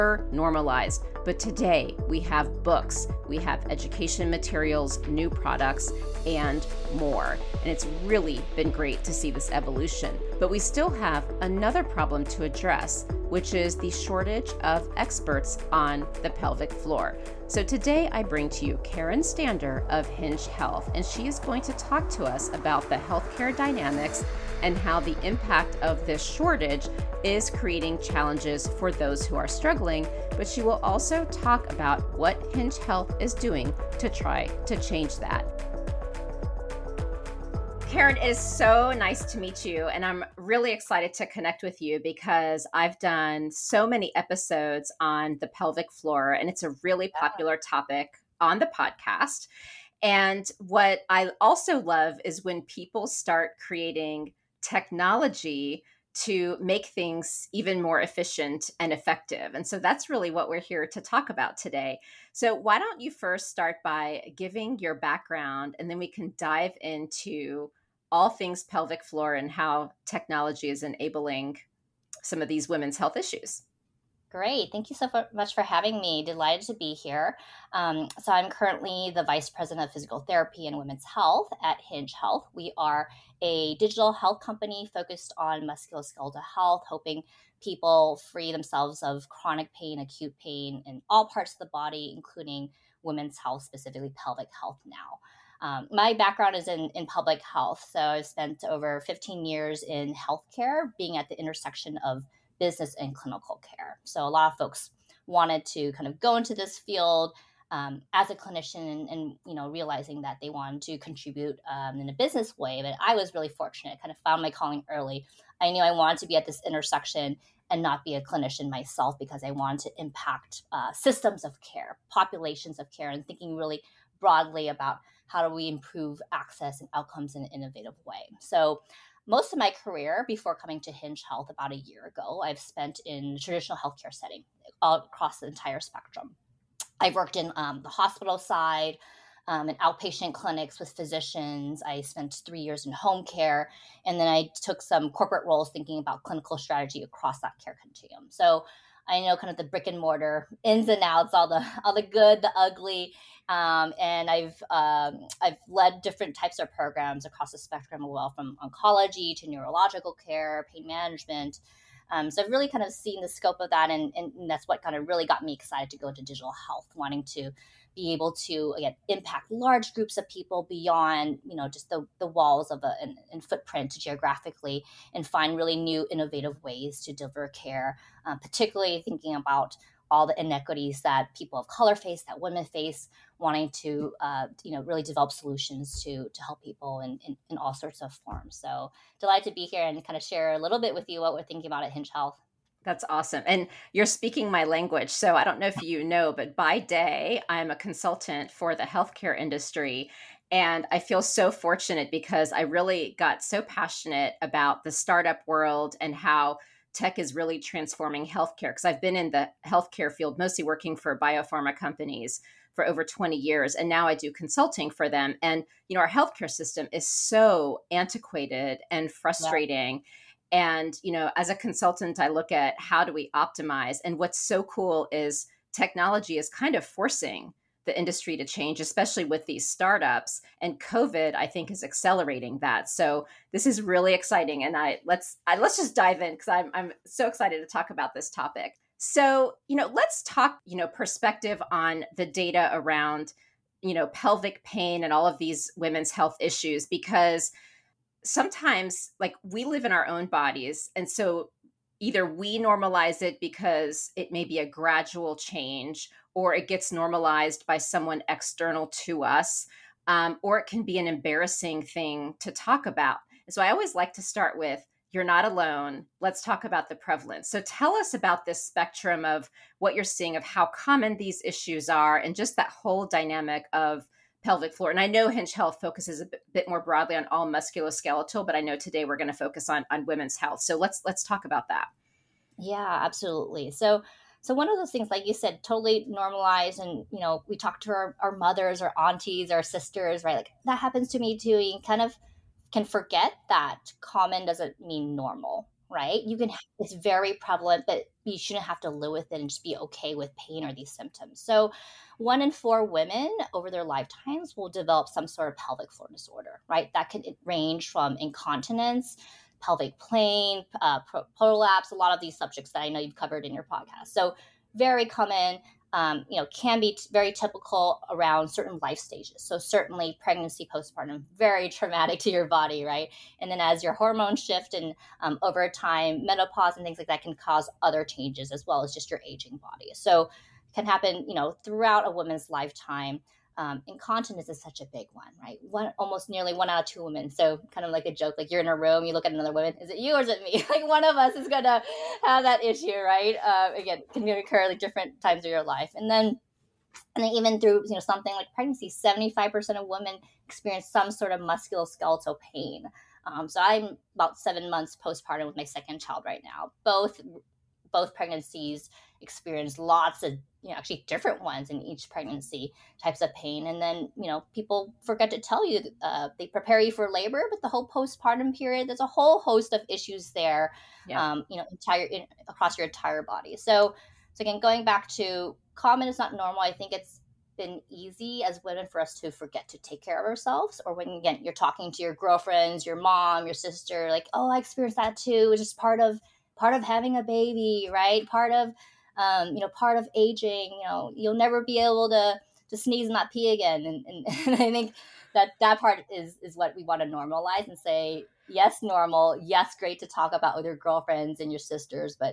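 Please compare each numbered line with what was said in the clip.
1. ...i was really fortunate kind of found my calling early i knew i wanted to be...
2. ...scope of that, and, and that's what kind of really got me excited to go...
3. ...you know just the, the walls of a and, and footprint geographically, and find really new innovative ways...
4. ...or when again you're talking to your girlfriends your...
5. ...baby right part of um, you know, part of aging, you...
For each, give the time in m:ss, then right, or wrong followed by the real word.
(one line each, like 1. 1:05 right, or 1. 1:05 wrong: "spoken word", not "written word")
1. 1:53 right
2. 2:43 right
3. 2:51 right
4. 6:20 right
5. 6:27 right.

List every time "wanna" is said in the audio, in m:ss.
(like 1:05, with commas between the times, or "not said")
not said.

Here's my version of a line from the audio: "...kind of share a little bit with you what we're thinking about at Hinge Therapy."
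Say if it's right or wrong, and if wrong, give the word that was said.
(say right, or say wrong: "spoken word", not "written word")
wrong: "Health", not "Therapy".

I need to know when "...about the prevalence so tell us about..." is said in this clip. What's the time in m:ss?
4:26.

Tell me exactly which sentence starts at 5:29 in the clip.
So can happen, you know, throughout a woman's lifetime um, incontinence is such a big one, right?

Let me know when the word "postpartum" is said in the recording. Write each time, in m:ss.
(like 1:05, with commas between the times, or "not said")
5:20, 5:55, 6:07.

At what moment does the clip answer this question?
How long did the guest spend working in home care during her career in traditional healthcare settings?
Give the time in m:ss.
2:22.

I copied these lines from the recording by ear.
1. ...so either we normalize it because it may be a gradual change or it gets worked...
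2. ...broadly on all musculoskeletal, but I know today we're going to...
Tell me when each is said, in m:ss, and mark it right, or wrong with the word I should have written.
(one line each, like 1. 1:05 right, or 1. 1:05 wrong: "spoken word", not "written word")
1. 4:11 wrong: "normalized", not "worked"
2. 4:36 right.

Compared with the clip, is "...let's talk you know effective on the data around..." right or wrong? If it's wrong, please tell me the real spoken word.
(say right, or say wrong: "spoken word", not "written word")
wrong: "perspective", not "effective".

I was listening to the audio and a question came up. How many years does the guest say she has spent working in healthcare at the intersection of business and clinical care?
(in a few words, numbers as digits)
Over 15 years.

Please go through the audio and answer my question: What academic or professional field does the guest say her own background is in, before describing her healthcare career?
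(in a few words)
Public health.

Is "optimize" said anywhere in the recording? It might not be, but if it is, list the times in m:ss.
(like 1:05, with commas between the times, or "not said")
3:43.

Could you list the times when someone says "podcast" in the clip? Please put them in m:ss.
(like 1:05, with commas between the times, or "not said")
0:48, 5:13.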